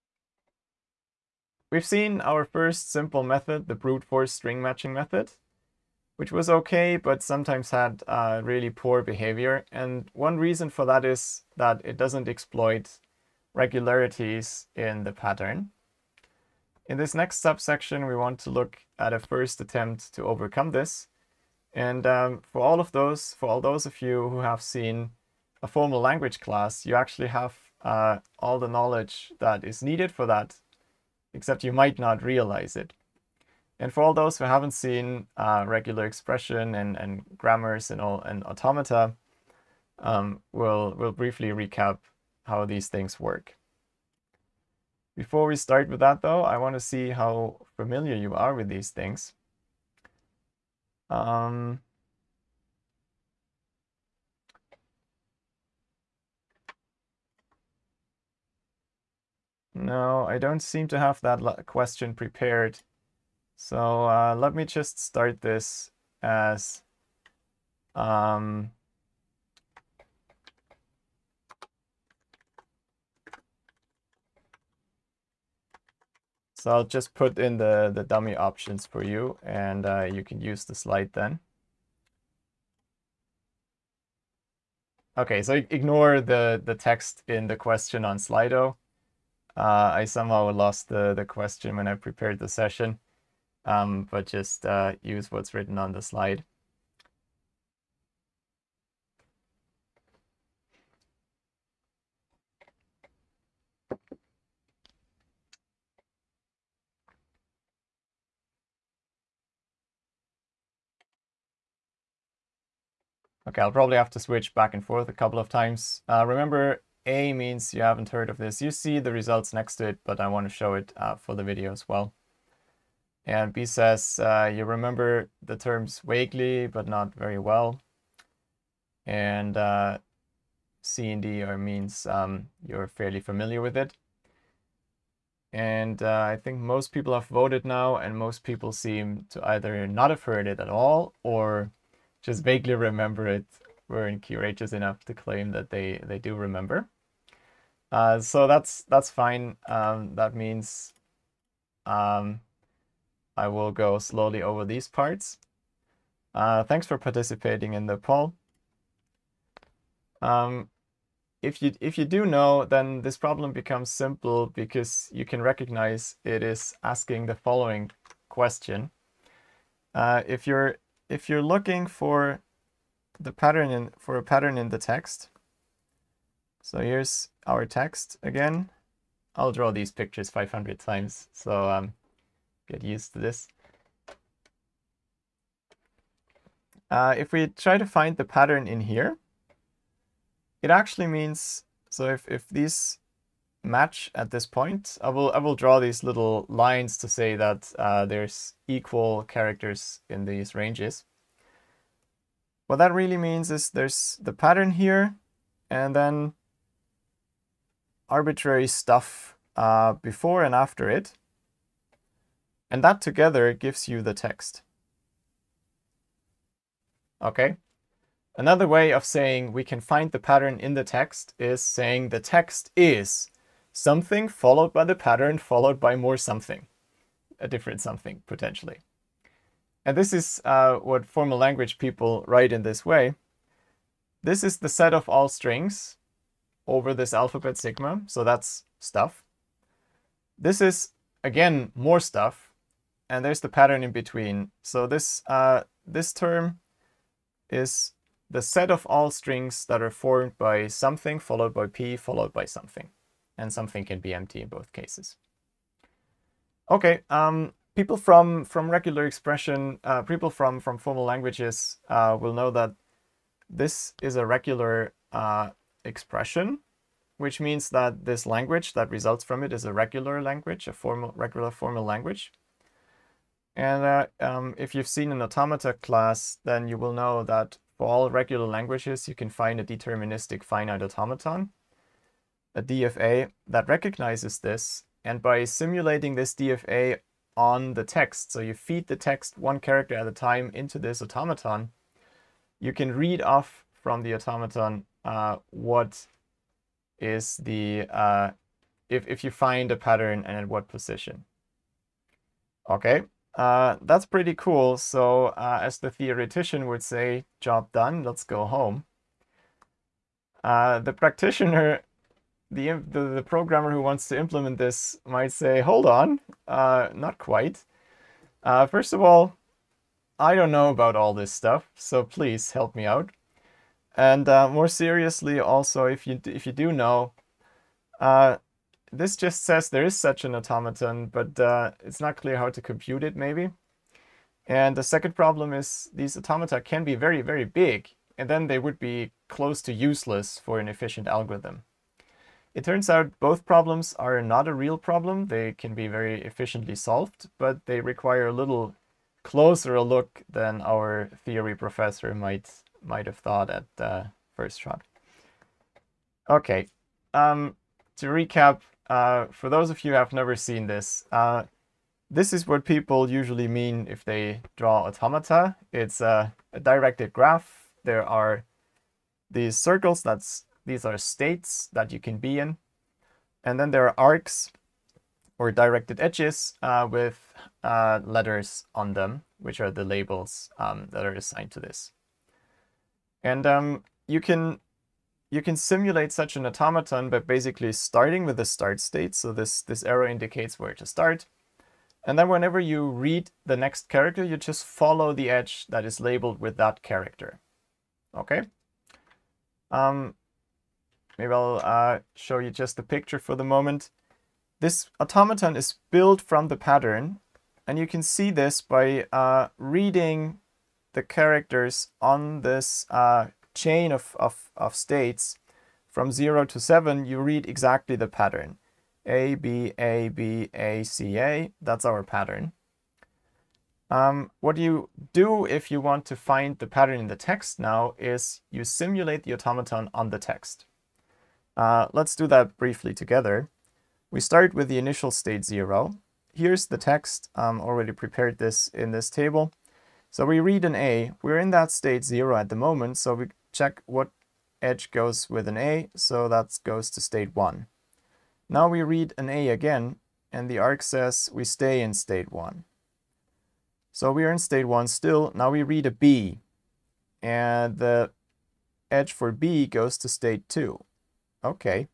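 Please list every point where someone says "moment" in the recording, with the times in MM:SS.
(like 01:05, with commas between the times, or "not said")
06:43, 07:22.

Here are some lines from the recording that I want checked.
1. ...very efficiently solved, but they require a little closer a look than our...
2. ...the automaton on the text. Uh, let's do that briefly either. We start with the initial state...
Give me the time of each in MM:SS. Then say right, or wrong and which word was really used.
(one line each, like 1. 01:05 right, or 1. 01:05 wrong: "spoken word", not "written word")
1. 05:45 right
2. 07:09 wrong: "together", not "either".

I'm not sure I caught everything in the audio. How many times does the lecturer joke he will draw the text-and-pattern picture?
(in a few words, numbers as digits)
500.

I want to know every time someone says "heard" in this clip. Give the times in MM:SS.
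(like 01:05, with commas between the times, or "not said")
01:58, 02:20.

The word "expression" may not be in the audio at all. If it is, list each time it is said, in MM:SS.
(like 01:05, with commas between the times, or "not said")
00:36, 04:19, 04:25.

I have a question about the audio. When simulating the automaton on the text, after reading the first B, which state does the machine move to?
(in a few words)
2.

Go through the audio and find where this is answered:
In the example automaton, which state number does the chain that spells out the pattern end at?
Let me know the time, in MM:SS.
06:56.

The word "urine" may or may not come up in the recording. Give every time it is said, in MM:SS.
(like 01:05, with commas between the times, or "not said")
not said.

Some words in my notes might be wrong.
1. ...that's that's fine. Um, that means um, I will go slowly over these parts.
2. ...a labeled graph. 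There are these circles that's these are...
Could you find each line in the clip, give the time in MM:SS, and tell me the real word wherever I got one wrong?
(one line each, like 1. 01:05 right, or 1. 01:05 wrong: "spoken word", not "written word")
1. 02:28 right
2. 06:06 wrong: "directed", not "labeled".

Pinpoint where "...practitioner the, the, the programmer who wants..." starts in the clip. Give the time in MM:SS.
05:10.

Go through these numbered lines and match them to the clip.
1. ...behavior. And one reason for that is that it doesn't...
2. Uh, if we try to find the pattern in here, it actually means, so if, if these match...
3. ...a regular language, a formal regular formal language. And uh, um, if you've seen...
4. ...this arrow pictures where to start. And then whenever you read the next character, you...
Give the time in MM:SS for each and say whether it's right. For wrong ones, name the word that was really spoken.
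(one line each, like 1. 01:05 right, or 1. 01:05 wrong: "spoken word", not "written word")
1. 00:09 right
2. 03:06 right
3. 04:29 right
4. 06:29 wrong: "indicates", not "pictures".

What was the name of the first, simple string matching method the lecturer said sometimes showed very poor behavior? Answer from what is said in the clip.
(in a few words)
brute force string matching.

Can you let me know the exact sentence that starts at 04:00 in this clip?
This is, again, more stuff, and there's the pattern in between.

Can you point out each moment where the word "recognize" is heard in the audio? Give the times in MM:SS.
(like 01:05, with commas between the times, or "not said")
02:45, 04:43.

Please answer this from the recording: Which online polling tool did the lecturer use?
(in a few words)
Slido.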